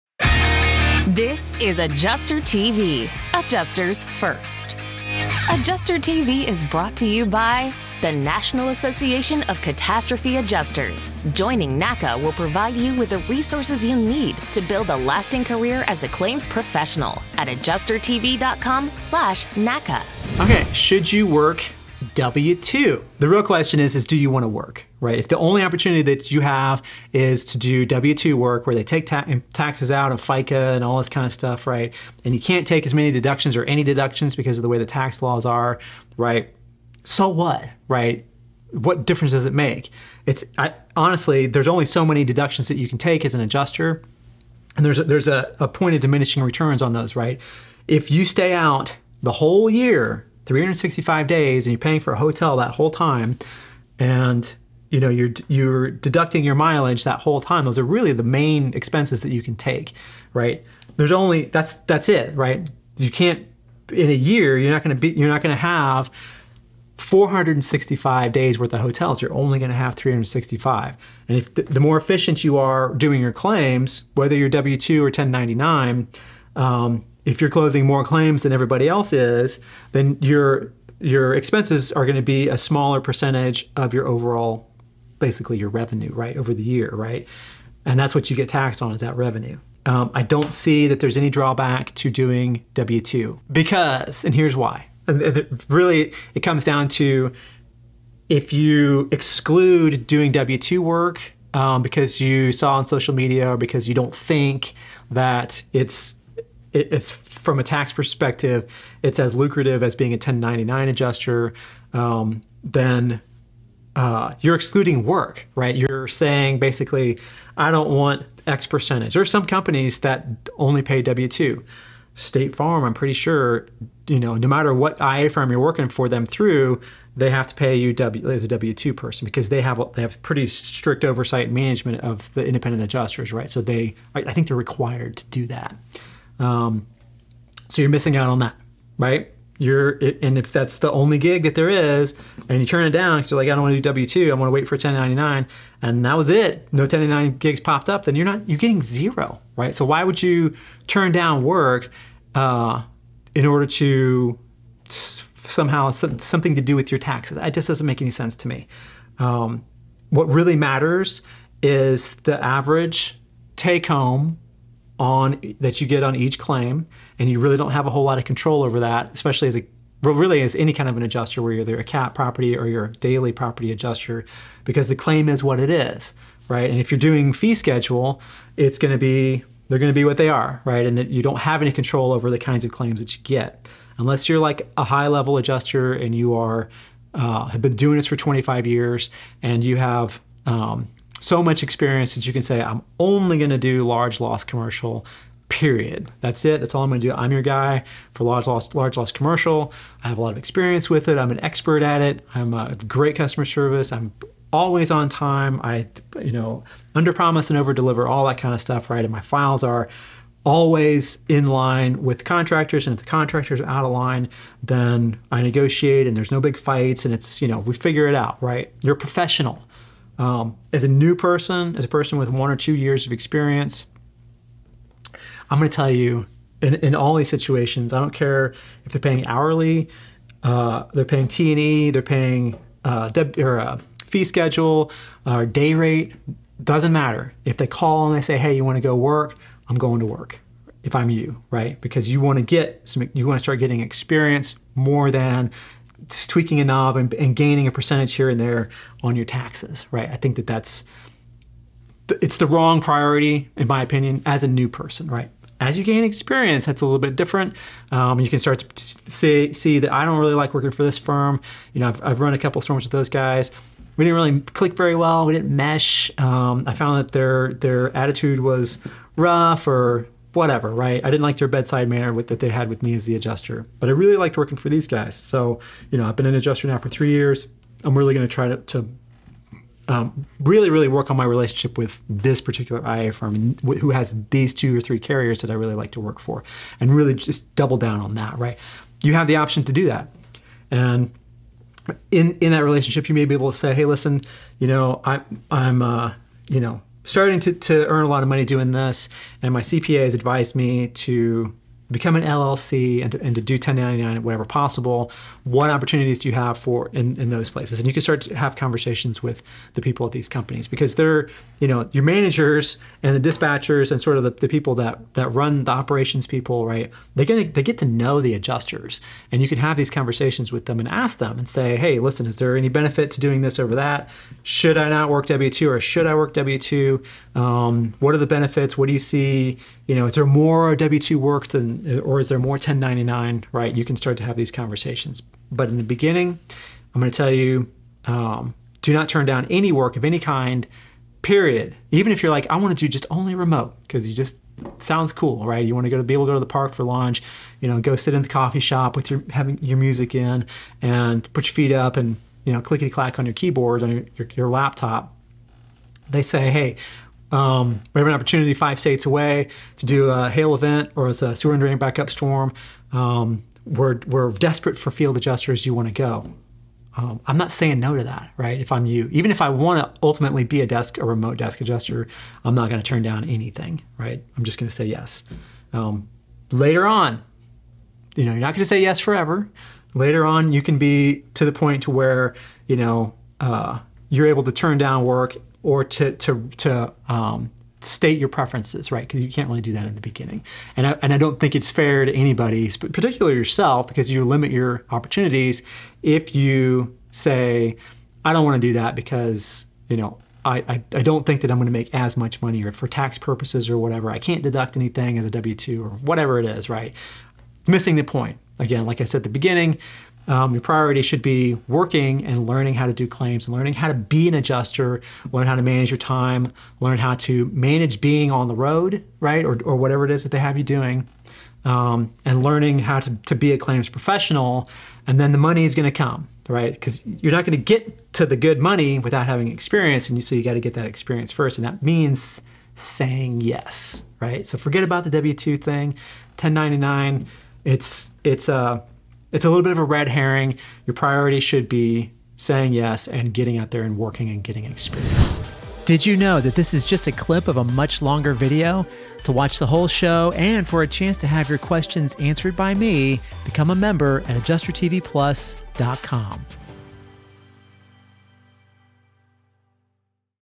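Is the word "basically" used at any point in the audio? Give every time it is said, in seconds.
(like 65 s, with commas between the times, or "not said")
85 s, 116 s.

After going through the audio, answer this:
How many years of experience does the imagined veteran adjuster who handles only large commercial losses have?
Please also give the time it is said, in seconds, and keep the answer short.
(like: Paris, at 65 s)
25, at 188 s.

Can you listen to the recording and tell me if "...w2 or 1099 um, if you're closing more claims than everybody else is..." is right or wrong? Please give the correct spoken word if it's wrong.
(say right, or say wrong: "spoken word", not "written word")
right.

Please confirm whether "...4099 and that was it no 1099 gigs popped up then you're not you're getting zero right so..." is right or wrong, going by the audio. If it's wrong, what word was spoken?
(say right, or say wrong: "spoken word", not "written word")
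wrong: "1099", not "4099".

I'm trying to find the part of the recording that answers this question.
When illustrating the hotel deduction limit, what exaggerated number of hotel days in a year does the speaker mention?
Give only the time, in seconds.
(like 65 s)
66 s.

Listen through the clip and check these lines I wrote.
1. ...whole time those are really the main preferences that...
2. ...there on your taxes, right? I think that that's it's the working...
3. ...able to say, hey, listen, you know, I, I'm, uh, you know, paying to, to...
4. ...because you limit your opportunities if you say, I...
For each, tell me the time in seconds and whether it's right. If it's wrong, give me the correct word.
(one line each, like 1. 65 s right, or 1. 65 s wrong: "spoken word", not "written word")
1. 57 s wrong: "expenses", not "preferences"
2. 248 s wrong: "wrong", not "working"
3. 293 s wrong: "starting", not "paying"
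4. 393 s right.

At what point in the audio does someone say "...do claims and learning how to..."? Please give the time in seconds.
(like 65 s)
412 s.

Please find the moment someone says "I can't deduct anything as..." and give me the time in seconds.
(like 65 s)
404 s.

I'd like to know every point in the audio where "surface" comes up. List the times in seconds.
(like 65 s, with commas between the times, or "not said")
not said.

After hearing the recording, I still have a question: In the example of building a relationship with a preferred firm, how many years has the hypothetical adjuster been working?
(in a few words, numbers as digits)
3.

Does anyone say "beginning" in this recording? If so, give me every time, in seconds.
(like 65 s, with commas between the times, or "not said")
335 s, 390 s, 409 s.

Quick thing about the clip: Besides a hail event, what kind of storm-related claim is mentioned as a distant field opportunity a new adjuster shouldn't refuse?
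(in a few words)
Sewer and drain backup.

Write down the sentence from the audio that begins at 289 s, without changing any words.
You have the option to do that.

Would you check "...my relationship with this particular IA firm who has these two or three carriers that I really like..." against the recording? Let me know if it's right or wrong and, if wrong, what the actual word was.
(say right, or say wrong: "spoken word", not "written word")
right.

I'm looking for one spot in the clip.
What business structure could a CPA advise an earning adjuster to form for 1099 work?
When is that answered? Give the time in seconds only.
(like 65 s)
302 s.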